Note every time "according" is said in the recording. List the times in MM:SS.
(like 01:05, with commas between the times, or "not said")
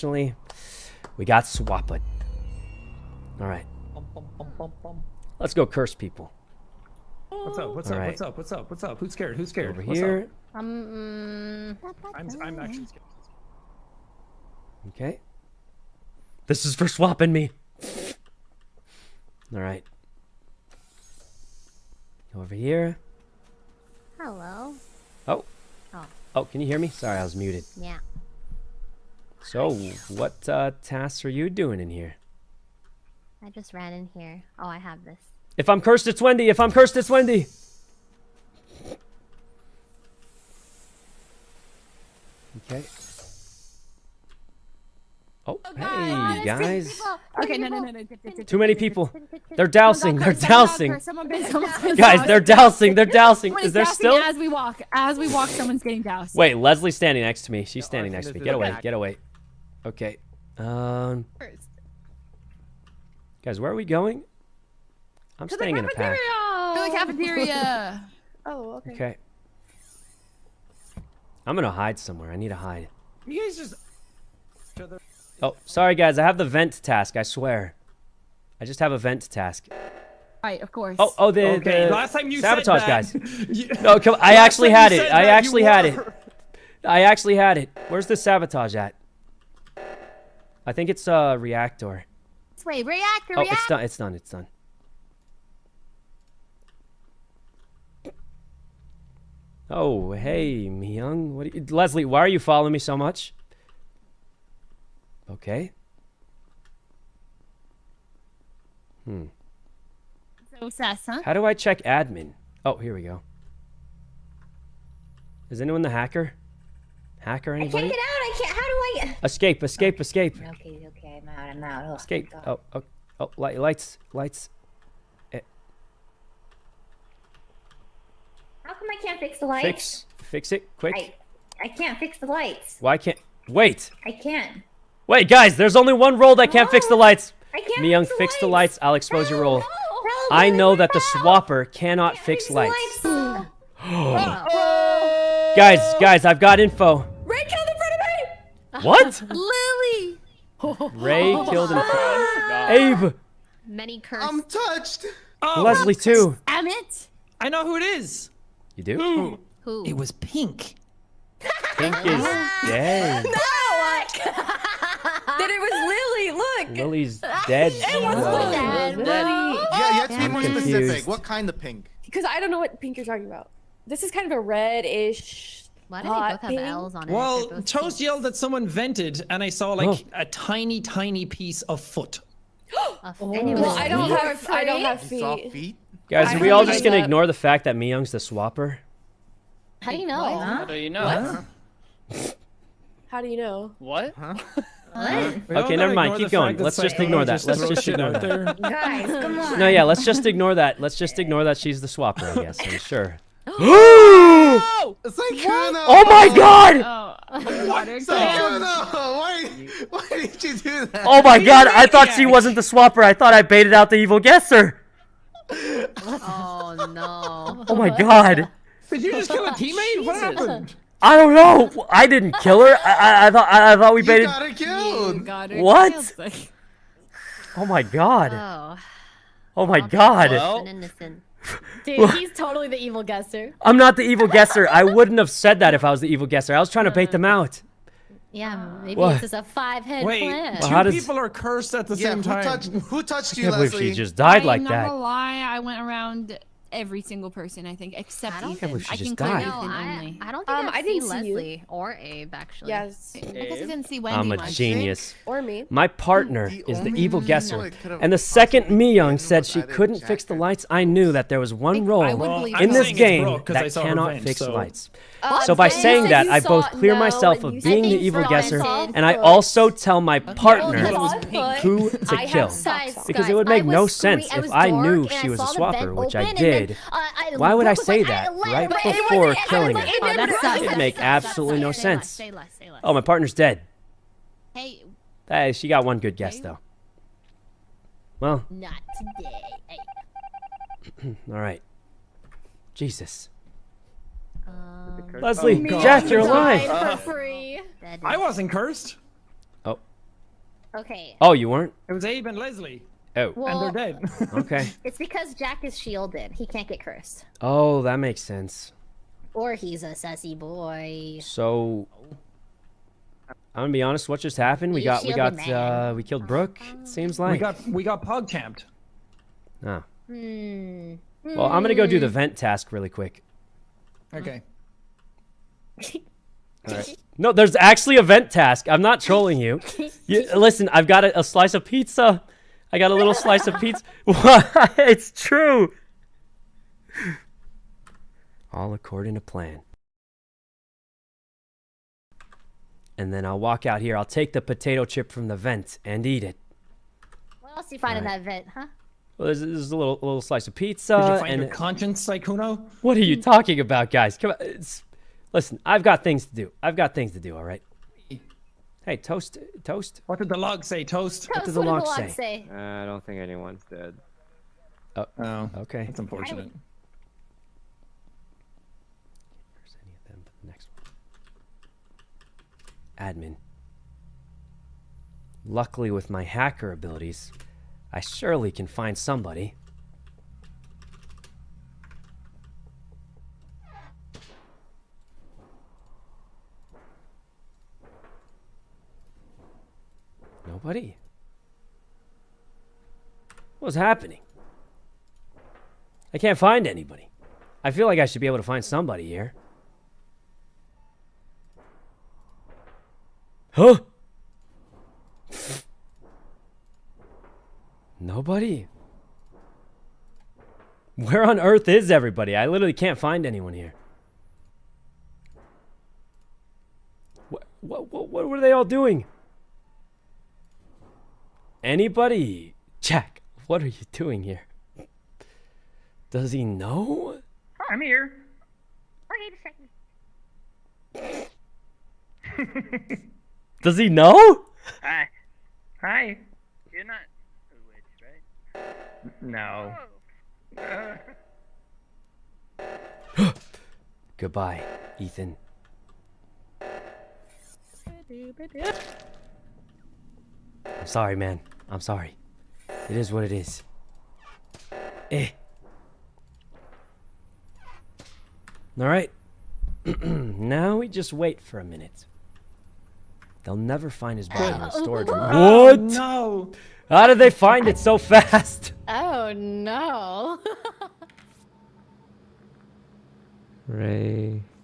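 05:38.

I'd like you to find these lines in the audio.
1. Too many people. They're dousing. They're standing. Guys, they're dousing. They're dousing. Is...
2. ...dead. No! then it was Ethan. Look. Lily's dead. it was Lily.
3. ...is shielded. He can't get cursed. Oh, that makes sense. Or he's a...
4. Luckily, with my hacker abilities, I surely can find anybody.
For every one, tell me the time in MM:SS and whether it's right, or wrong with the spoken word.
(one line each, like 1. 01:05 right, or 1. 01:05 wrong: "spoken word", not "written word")
1. 00:48 wrong: "dousing", not "standing"
2. 02:42 wrong: "Lily", not "Ethan"
3. 05:05 right
4. 06:15 wrong: "somebody", not "anybody".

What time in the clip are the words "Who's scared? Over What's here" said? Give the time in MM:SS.
00:09.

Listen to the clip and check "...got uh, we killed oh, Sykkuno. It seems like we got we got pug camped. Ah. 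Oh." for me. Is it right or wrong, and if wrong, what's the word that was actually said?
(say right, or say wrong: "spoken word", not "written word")
wrong: "Brooke", not "Sykkuno".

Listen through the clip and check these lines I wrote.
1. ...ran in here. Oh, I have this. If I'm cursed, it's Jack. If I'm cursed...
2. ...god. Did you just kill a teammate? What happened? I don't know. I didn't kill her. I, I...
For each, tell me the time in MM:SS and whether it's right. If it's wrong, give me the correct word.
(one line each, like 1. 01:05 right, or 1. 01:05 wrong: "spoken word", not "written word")
1. 00:33 wrong: "Wendy", not "Jack"
2. 03:37 right.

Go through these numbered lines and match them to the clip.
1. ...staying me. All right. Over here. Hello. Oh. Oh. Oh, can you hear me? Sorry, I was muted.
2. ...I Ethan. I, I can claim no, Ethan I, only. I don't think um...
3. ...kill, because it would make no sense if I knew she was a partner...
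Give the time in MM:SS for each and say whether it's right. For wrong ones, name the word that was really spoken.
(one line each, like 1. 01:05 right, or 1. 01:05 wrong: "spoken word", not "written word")
1. 00:16 wrong: "swapping", not "staying"
2. 04:08 right
3. 04:32 wrong: "swapper", not "partner".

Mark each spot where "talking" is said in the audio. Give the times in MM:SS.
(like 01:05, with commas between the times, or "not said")
02:53, 05:53.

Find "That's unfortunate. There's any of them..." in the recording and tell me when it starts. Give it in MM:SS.
06:05.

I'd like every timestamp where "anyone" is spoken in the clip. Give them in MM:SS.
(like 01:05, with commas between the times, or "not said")
01:55, 06:03, 06:53.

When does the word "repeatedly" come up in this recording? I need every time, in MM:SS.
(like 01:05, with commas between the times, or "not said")
not said.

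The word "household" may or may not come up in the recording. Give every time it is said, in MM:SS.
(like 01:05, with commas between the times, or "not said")
not said.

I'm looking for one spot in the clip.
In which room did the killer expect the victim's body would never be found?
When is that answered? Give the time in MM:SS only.
07:44.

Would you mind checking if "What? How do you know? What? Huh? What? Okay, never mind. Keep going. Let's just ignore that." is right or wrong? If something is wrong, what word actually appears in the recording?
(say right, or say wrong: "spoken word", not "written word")
right.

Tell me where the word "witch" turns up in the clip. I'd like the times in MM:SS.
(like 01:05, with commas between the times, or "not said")
07:17.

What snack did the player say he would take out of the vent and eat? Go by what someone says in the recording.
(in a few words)
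Potato chip.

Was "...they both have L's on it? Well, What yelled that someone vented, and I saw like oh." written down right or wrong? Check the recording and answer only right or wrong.
wrong.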